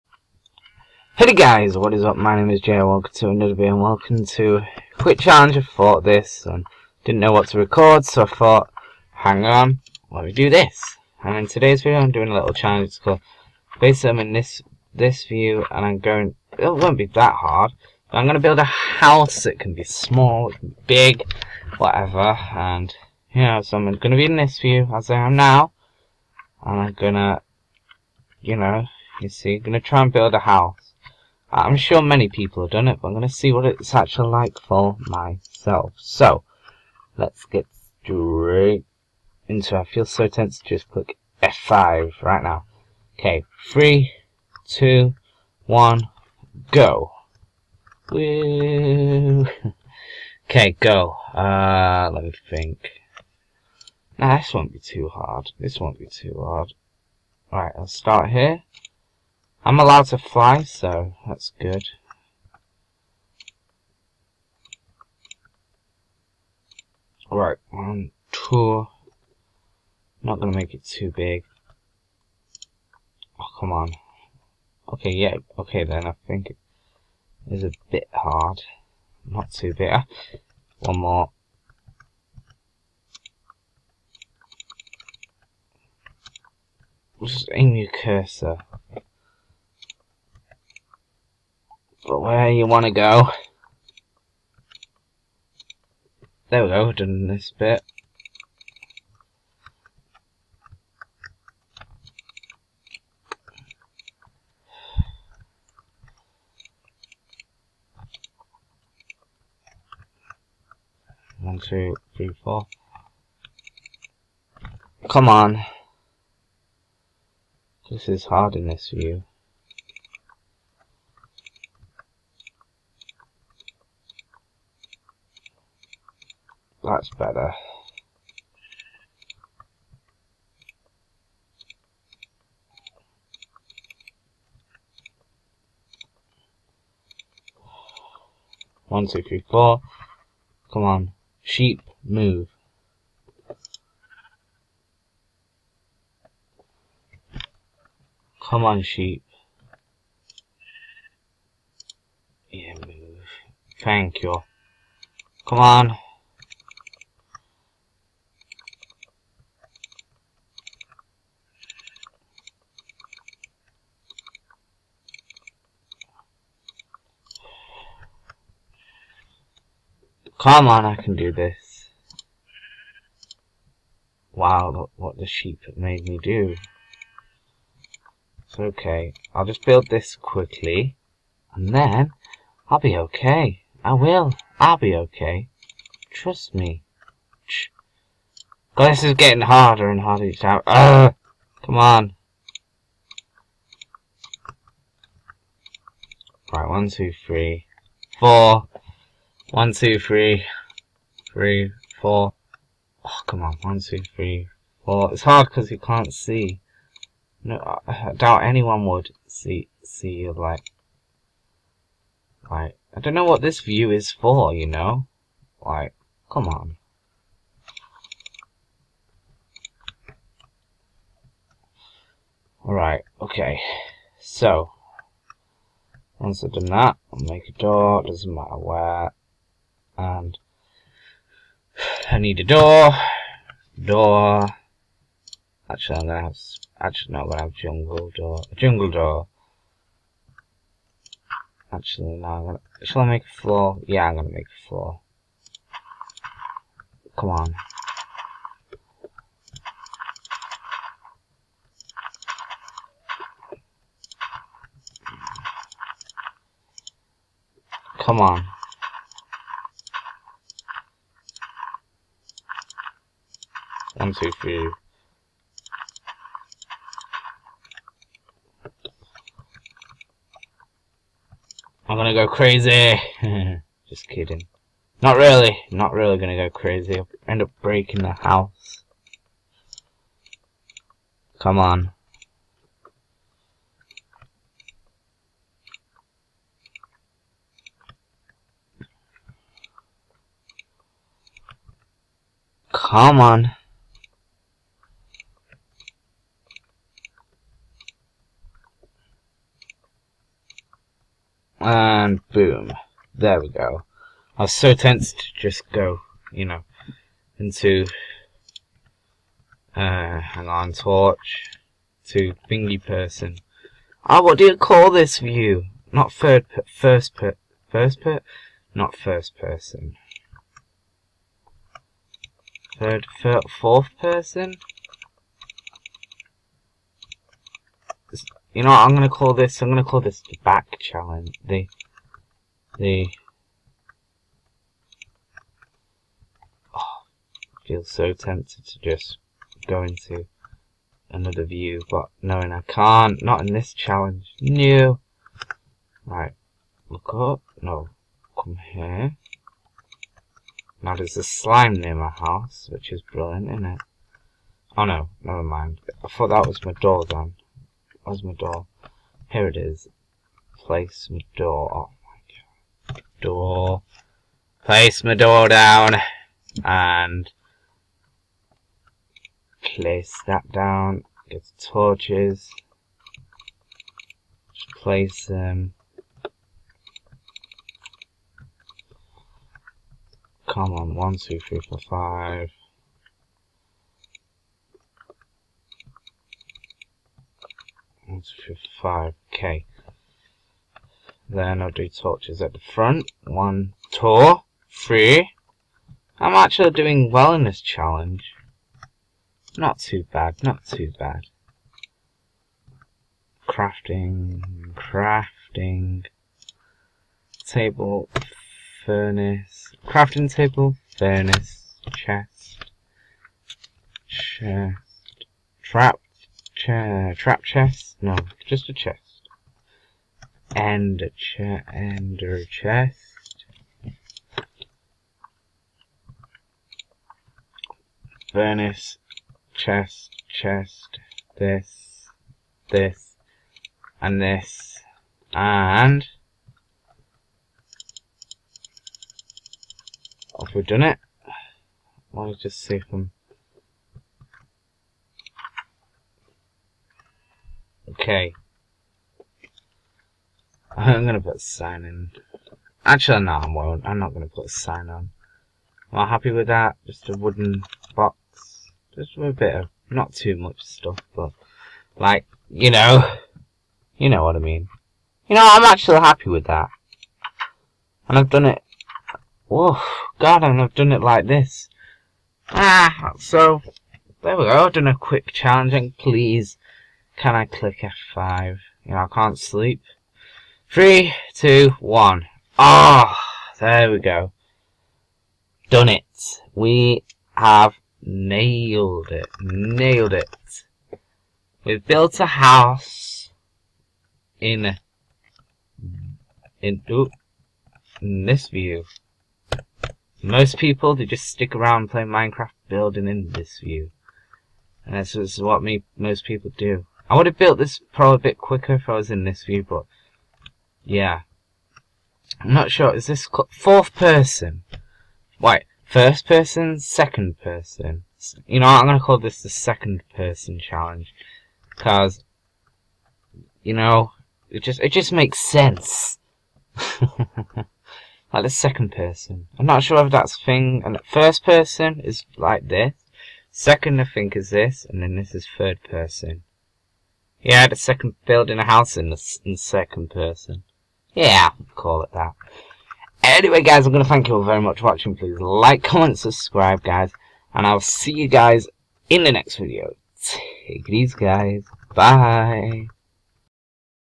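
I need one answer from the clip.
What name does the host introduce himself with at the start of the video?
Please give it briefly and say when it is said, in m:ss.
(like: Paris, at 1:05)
Jay, at 0:02.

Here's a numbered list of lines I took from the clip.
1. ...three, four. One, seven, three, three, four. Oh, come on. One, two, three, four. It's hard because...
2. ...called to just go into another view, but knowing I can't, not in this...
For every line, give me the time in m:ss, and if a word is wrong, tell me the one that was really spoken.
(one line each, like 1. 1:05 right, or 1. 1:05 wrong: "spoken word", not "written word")
1. 3:17 wrong: "two", not "seven"
2. 5:38 wrong: "tempted", not "called".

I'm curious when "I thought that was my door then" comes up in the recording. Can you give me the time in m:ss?
5:56.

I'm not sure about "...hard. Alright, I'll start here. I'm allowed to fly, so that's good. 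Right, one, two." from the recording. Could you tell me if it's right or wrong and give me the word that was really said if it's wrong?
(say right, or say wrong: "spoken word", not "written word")
right.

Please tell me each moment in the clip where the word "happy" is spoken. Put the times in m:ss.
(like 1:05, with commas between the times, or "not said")
7:36, 7:45.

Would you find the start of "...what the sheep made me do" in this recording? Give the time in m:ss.
2:54.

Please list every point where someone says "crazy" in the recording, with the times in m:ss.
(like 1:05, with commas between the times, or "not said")
4:32, 4:36.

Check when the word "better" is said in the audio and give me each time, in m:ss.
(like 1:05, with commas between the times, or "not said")
2:07.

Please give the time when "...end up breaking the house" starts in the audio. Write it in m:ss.
4:37.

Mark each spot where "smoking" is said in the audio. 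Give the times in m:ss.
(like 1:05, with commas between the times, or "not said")
not said.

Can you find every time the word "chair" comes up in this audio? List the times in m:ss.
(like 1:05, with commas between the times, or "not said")
6:56, 7:01.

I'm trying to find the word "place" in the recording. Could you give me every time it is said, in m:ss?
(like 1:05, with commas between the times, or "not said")
6:00, 6:04, 6:09, 6:14.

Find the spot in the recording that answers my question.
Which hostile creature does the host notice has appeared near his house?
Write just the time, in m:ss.
5:51.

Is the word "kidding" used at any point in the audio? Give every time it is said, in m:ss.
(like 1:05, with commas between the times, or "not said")
4:34.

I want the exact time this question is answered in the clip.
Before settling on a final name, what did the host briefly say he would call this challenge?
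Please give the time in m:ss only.
5:30.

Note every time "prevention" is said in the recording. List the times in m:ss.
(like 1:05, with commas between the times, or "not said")
not said.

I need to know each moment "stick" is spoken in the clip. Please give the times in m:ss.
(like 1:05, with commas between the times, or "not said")
8:21.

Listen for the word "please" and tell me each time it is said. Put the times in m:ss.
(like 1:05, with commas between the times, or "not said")
7:55, 9:05.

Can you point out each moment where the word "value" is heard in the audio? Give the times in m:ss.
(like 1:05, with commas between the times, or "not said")
not said.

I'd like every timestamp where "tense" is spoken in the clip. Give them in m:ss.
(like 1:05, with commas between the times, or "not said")
0:40, 5:04.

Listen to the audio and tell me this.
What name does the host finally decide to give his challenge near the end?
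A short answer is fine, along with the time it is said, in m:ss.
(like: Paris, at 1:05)
Second person challenge, at 8:39.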